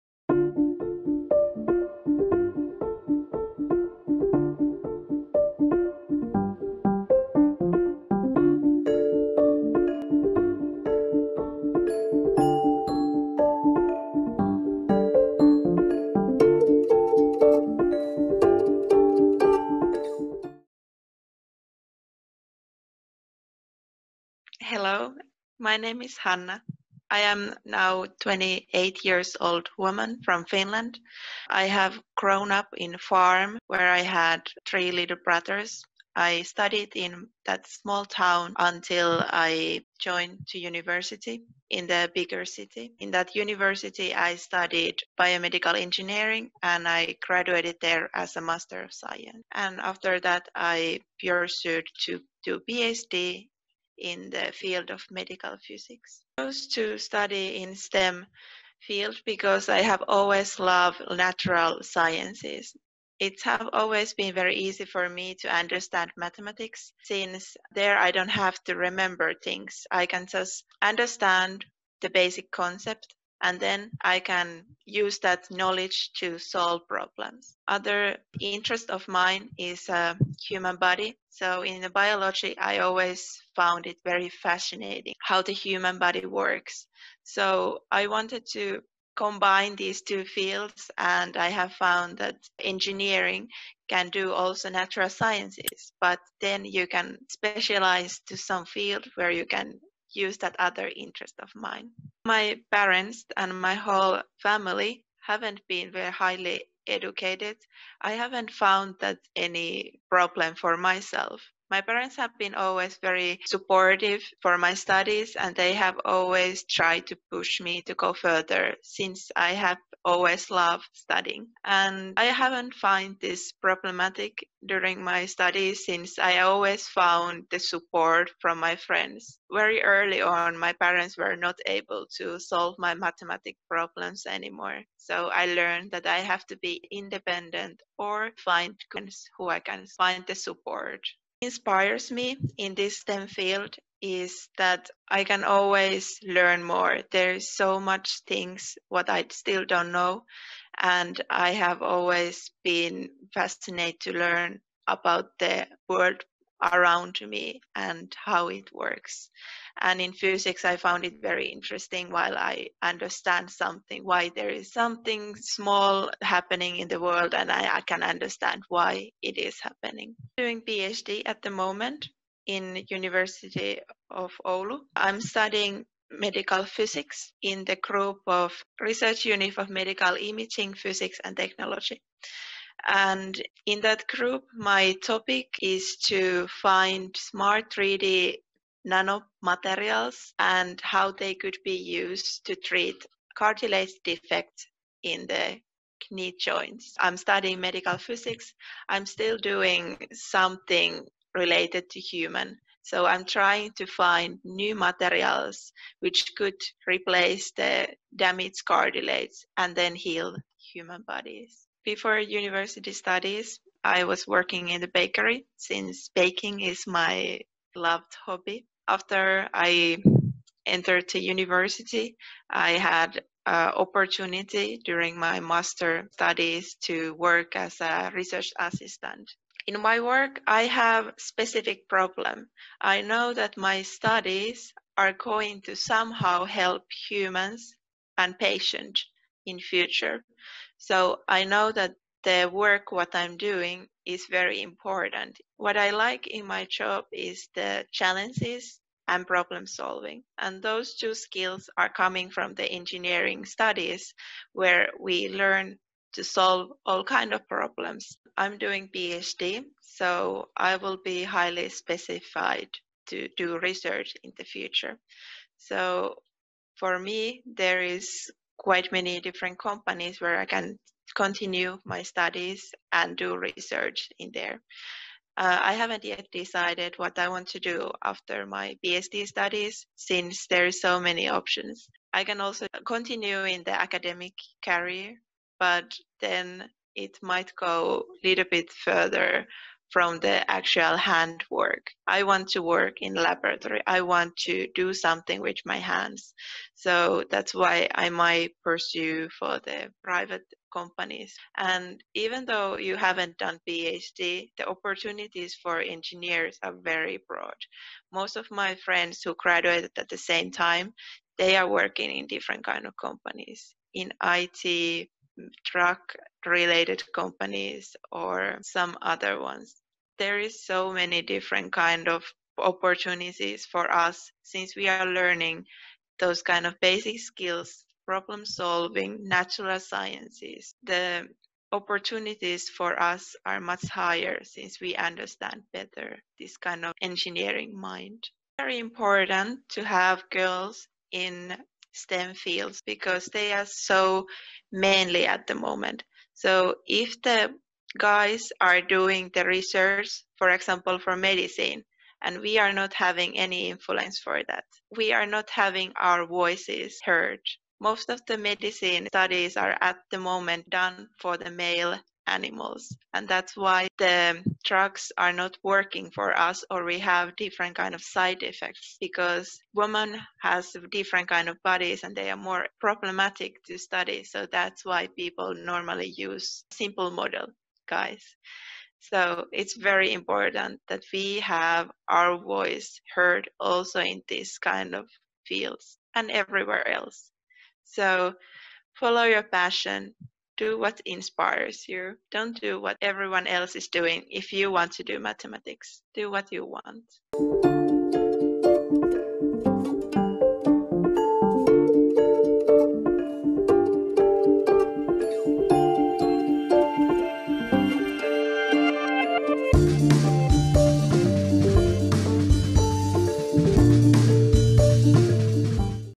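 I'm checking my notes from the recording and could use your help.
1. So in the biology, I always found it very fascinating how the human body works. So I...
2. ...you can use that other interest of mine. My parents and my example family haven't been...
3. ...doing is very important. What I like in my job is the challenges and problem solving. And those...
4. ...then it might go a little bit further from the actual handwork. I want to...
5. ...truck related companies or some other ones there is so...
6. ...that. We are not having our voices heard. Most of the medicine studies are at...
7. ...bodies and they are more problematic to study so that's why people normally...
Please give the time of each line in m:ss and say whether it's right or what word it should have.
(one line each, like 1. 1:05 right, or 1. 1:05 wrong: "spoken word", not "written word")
1. 1:21 right
2. 1:39 wrong: "whole", not "example"
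3. 4:03 right
4. 4:46 right
5. 5:15 right
6. 5:54 right
7. 6:11 right.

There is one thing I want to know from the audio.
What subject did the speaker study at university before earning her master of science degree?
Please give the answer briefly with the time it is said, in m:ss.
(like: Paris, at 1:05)
Biomedical engineering, at 0:45.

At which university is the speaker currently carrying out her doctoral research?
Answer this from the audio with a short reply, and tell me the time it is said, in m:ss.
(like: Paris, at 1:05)
University of Oulu, at 2:52.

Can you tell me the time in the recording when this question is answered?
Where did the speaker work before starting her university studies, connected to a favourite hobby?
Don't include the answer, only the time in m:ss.
3:34.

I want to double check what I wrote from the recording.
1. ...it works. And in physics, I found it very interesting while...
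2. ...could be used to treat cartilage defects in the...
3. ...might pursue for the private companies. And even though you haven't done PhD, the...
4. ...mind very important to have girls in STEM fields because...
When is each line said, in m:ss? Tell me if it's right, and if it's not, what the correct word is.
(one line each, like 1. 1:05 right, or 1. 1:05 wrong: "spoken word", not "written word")
1. 2:38 right
2. 3:11 right
3. 4:58 right
4. 5:37 right.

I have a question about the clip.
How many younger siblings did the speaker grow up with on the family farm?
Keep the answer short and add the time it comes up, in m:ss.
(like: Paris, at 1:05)
3, at 0:34.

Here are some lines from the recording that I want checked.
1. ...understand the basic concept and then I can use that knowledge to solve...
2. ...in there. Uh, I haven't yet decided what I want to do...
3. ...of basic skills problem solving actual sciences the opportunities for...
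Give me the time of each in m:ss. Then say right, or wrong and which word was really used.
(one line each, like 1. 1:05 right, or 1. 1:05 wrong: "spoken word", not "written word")
1. 1:10 right
2. 4:34 right
3. 5:26 wrong: "natural", not "actual".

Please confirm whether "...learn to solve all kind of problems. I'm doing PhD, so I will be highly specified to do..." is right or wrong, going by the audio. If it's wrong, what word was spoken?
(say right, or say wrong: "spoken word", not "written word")
right.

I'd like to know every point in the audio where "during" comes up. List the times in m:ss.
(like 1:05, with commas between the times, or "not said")
2:04, 3:44.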